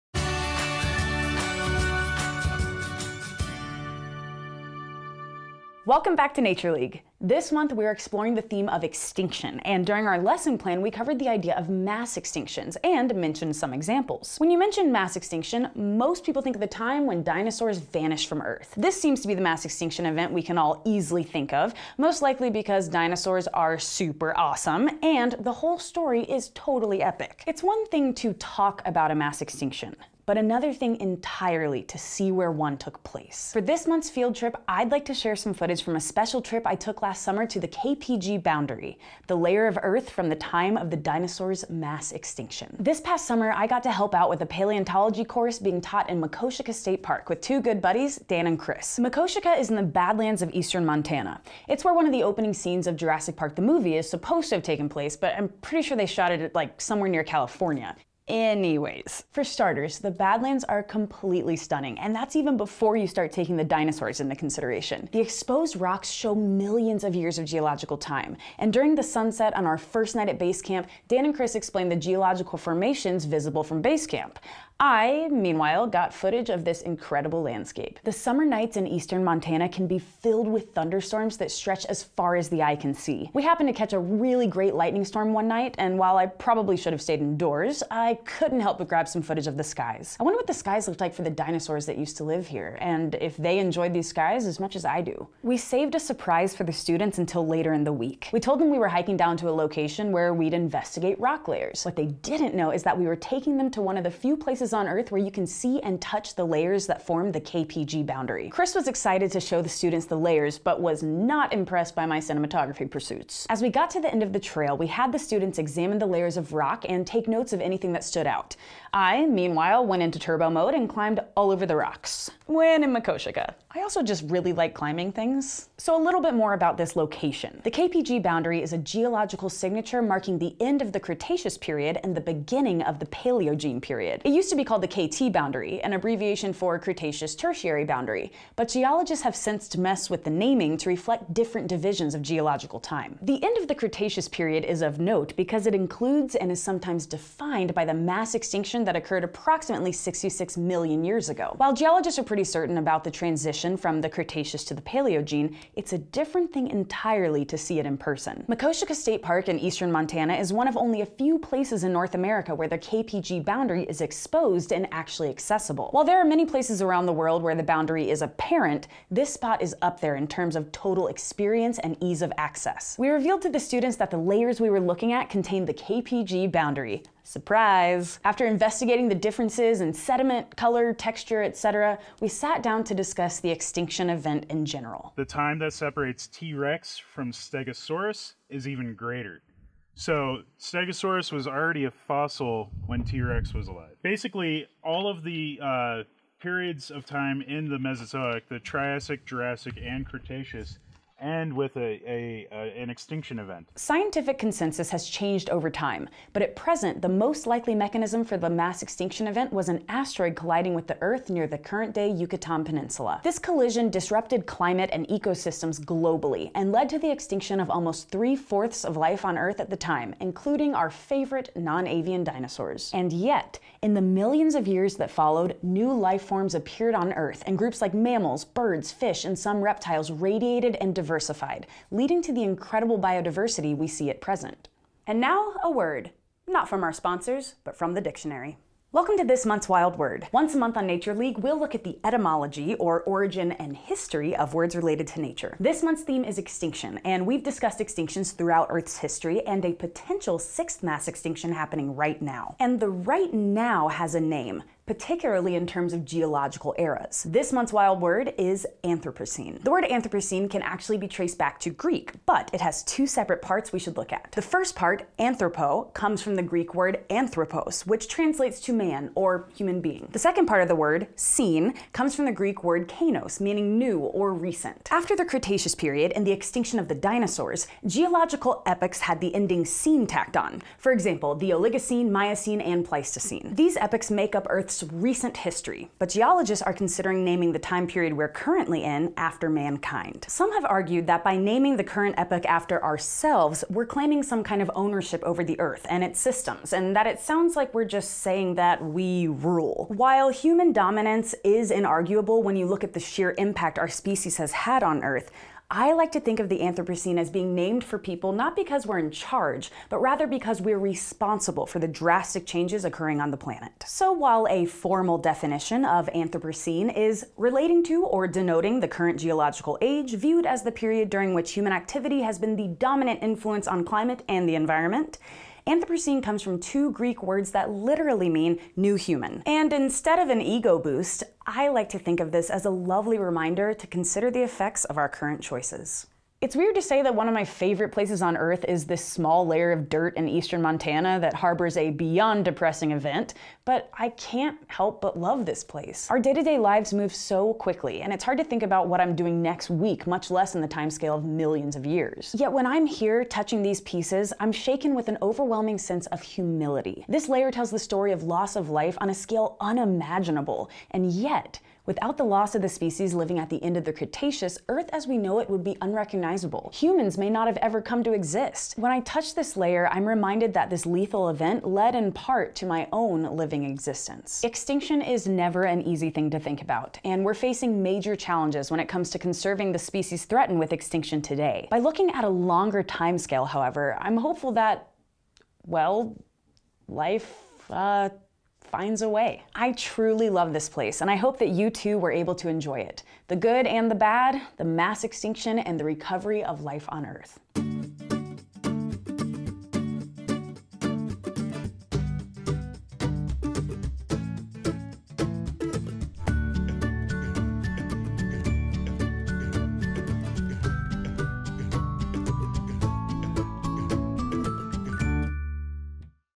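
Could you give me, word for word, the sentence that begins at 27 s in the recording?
It's one thing to talk about a mass extinction, but another thing entirely to see where one took place.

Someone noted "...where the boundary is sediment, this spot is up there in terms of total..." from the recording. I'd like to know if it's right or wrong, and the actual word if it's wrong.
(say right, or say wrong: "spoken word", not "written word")
wrong: "apparent", not "sediment".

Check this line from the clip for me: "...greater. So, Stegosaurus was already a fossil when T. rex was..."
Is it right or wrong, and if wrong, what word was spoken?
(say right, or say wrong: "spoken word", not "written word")
right.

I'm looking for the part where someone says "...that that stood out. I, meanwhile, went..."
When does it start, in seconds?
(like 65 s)
117 s.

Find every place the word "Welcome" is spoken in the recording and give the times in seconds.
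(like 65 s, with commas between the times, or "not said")
5 s, 238 s.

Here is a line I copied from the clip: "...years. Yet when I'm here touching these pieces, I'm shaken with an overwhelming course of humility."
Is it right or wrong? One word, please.
wrong.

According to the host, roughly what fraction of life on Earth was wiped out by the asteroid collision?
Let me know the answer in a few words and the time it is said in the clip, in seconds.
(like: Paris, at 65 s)
Almost three fourths, at 217 s.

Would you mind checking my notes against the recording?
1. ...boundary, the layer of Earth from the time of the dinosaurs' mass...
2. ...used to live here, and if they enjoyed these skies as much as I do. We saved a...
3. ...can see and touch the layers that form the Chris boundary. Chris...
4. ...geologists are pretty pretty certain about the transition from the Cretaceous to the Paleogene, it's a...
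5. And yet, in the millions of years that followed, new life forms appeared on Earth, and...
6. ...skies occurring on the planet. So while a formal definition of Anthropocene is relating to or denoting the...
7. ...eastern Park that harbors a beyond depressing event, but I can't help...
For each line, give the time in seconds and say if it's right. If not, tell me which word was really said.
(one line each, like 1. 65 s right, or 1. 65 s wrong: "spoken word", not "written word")
1. 38 s right
2. 91 s right
3. 105 s wrong: "KPG", not "Chris"
4. 151 s right
5. 222 s right
6. 312 s wrong: "changes", not "skies"
7. 340 s wrong: "Montana", not "Park".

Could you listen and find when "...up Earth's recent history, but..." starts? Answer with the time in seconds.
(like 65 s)
284 s.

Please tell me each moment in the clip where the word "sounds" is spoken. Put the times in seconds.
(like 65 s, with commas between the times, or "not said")
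297 s.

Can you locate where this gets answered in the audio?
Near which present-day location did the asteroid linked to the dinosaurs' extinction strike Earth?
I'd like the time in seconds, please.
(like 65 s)
212 s.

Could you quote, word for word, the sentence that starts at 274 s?
After the Cretaceous period and the extinction of the dinosaurs, geological epochs had the ending cene tacked on.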